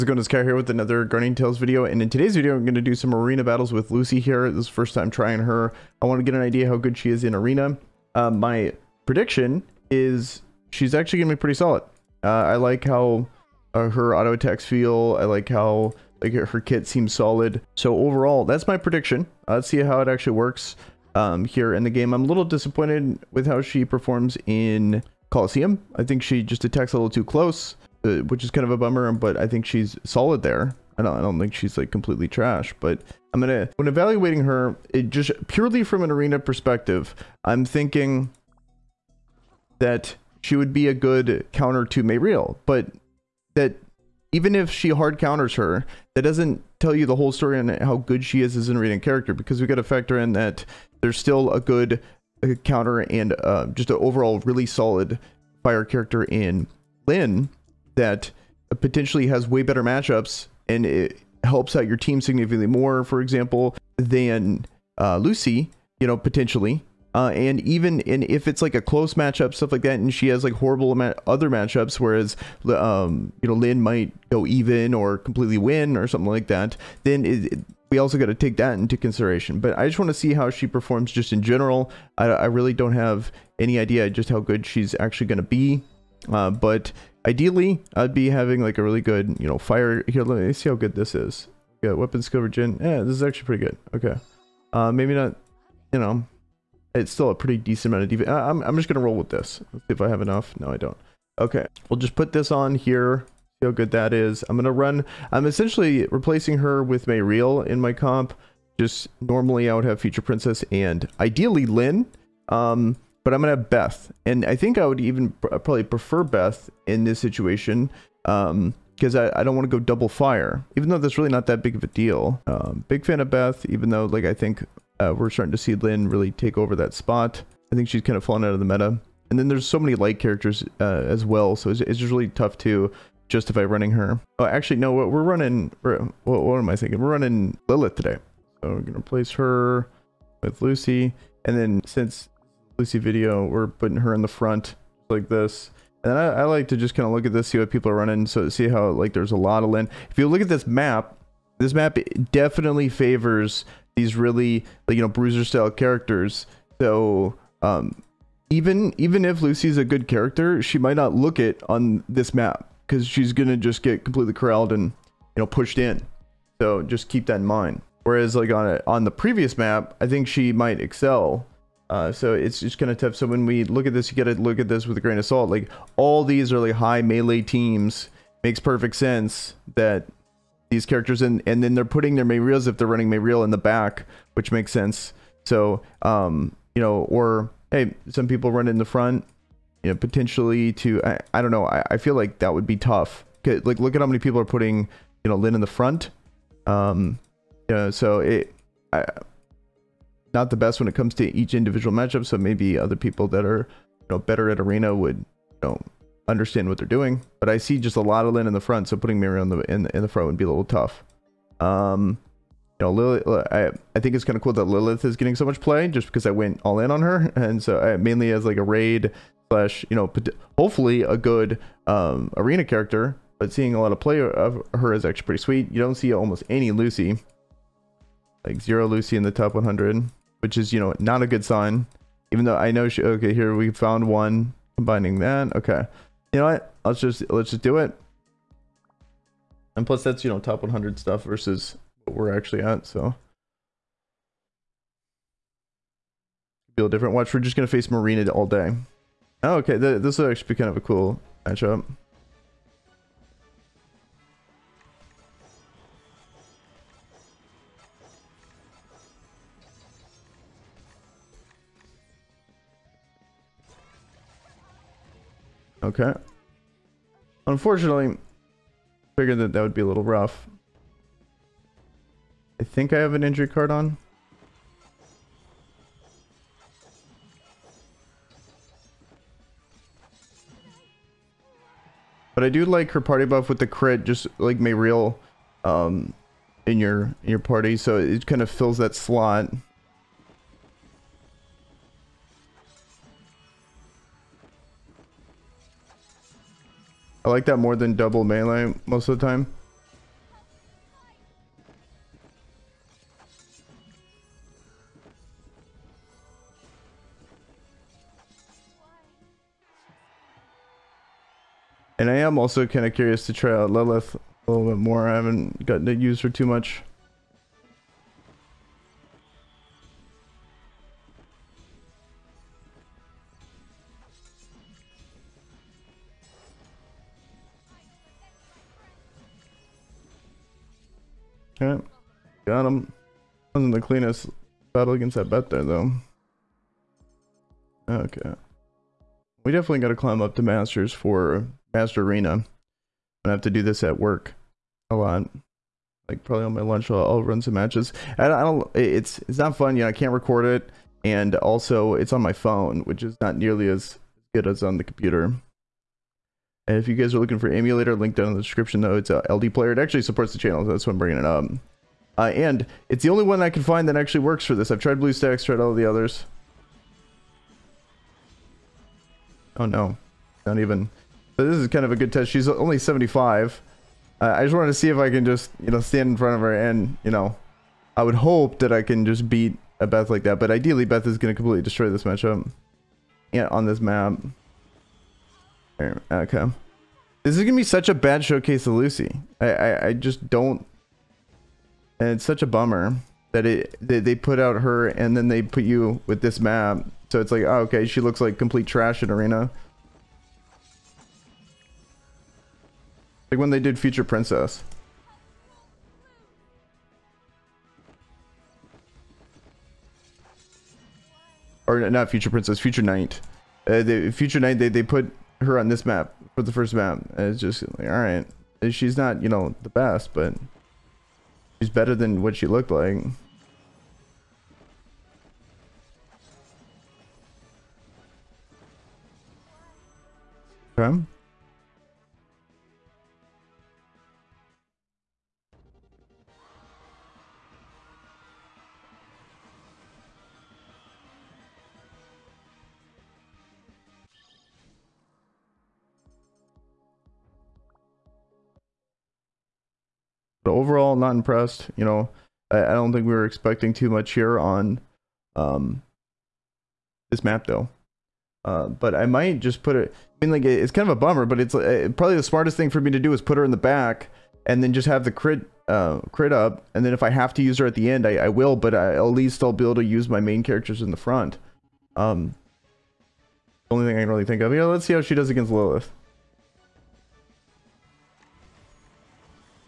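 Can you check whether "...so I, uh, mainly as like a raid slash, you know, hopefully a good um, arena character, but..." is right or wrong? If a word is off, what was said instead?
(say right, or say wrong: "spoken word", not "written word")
right.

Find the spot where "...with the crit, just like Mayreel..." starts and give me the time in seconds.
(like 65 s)
283 s.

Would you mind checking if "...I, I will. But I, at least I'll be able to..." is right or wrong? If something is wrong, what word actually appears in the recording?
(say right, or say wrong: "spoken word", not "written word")
right.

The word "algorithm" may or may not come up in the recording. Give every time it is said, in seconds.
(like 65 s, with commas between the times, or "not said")
not said.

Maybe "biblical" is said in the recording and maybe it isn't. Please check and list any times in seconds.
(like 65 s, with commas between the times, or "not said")
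not said.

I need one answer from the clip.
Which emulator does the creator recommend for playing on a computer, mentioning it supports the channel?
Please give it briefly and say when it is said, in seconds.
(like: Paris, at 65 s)
LD Player, at 359 s.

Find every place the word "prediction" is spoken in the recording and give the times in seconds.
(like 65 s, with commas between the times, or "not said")
9 s, 18 s.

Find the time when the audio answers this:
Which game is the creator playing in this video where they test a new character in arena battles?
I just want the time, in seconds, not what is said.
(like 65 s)
1 s.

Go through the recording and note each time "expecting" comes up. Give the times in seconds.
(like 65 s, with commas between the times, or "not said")
453 s.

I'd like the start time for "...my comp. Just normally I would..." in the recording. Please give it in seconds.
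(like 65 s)
107 s.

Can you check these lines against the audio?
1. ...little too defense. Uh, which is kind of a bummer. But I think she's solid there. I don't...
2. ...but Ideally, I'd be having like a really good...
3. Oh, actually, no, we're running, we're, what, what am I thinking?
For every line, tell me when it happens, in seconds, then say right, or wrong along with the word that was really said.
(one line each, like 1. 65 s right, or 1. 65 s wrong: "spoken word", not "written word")
1. 26 s wrong: "close", not "defense"
2. 86 s right
3. 134 s right.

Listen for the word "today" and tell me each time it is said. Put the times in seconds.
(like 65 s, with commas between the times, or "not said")
2 s, 137 s.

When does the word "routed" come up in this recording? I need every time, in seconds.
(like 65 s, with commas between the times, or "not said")
not said.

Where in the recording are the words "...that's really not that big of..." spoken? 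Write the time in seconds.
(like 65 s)
120 s.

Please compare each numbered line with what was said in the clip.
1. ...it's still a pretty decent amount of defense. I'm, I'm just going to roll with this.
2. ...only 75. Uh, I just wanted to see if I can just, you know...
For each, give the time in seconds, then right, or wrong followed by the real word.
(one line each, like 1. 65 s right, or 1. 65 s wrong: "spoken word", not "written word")
1. 96 s right
2. 372 s right.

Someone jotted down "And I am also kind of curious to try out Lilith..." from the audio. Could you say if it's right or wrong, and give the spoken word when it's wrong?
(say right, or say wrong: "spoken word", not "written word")
right.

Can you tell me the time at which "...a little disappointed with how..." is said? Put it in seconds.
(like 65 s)
22 s.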